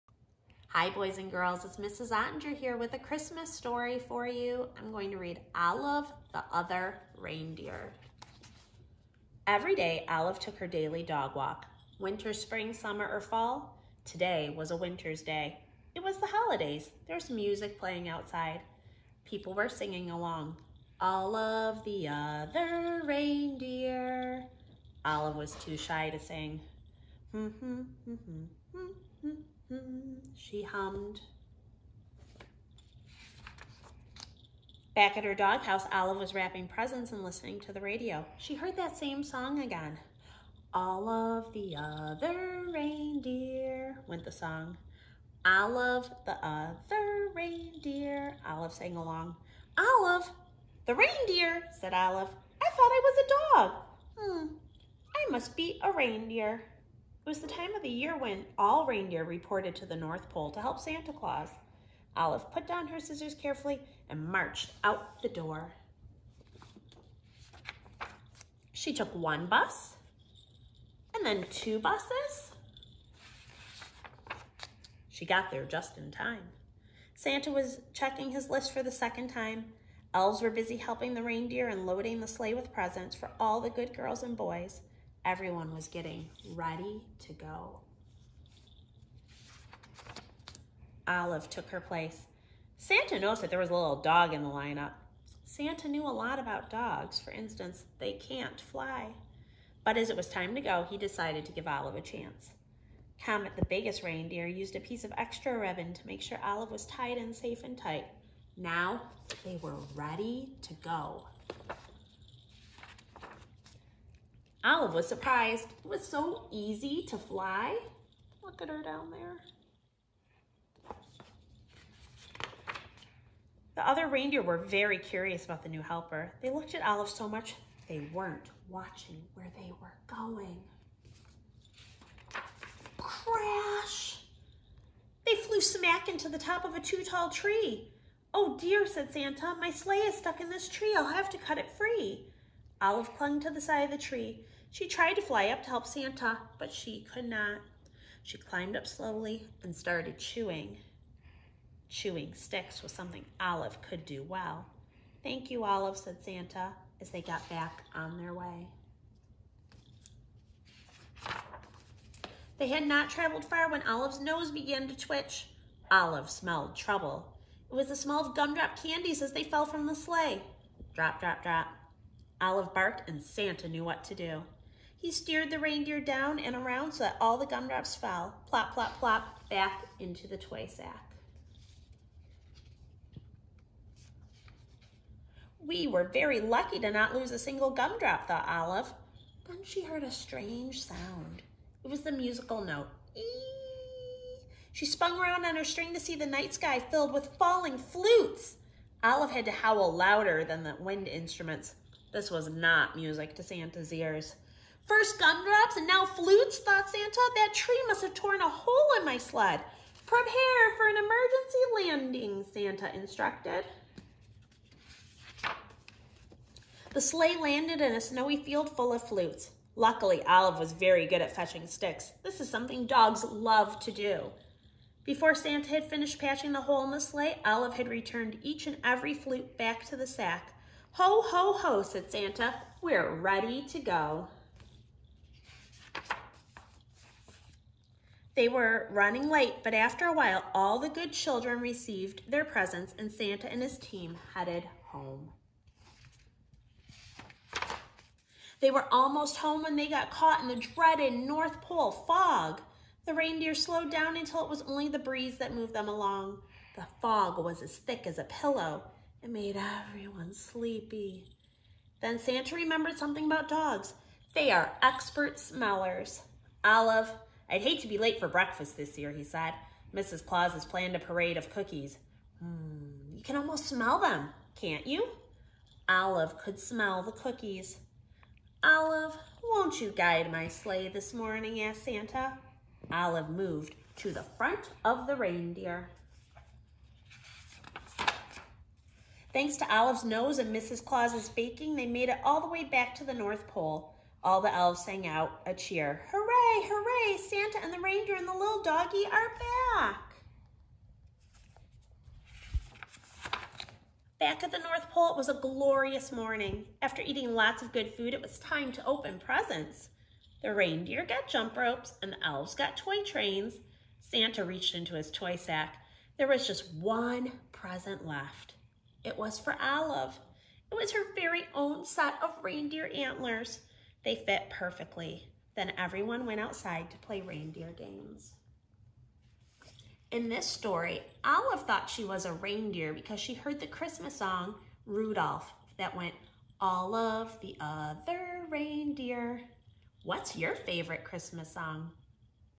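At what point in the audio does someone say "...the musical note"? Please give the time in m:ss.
3:12.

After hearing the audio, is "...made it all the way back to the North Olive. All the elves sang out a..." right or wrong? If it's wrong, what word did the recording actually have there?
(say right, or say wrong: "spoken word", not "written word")
wrong: "Pole", not "Olive".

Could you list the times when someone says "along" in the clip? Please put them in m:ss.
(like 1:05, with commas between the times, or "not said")
0:20, 0:48, 4:15.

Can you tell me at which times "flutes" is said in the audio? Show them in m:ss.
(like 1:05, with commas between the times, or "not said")
3:17, 3:26, 3:39, 3:49.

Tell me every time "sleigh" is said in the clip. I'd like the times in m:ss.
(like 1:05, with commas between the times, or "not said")
1:22, 2:19, 2:49, 3:36, 3:46, 4:40.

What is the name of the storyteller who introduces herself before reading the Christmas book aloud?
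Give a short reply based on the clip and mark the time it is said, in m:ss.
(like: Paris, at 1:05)
Mrs. Ottinger, at 0:01.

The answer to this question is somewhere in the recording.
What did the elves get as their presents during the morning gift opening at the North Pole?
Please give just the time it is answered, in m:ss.
5:12.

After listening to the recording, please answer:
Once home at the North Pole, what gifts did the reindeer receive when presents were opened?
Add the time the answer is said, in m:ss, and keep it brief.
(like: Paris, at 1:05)
Jump ropes, at 5:11.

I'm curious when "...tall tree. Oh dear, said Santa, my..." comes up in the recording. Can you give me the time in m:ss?
2:17.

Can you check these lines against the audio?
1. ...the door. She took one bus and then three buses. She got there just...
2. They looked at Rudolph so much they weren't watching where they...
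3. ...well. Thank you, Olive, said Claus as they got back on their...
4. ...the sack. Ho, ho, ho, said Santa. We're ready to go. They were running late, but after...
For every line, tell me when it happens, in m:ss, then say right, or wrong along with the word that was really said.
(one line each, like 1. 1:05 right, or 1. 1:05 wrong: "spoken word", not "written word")
1. 1:05 wrong: "two", not "three"
2. 2:06 wrong: "Olive", not "Rudolph"
3. 2:34 wrong: "Santa", not "Claus"
4. 3:49 right.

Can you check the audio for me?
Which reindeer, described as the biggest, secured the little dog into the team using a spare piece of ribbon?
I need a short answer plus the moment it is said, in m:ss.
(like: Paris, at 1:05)
Comet, at 1:43.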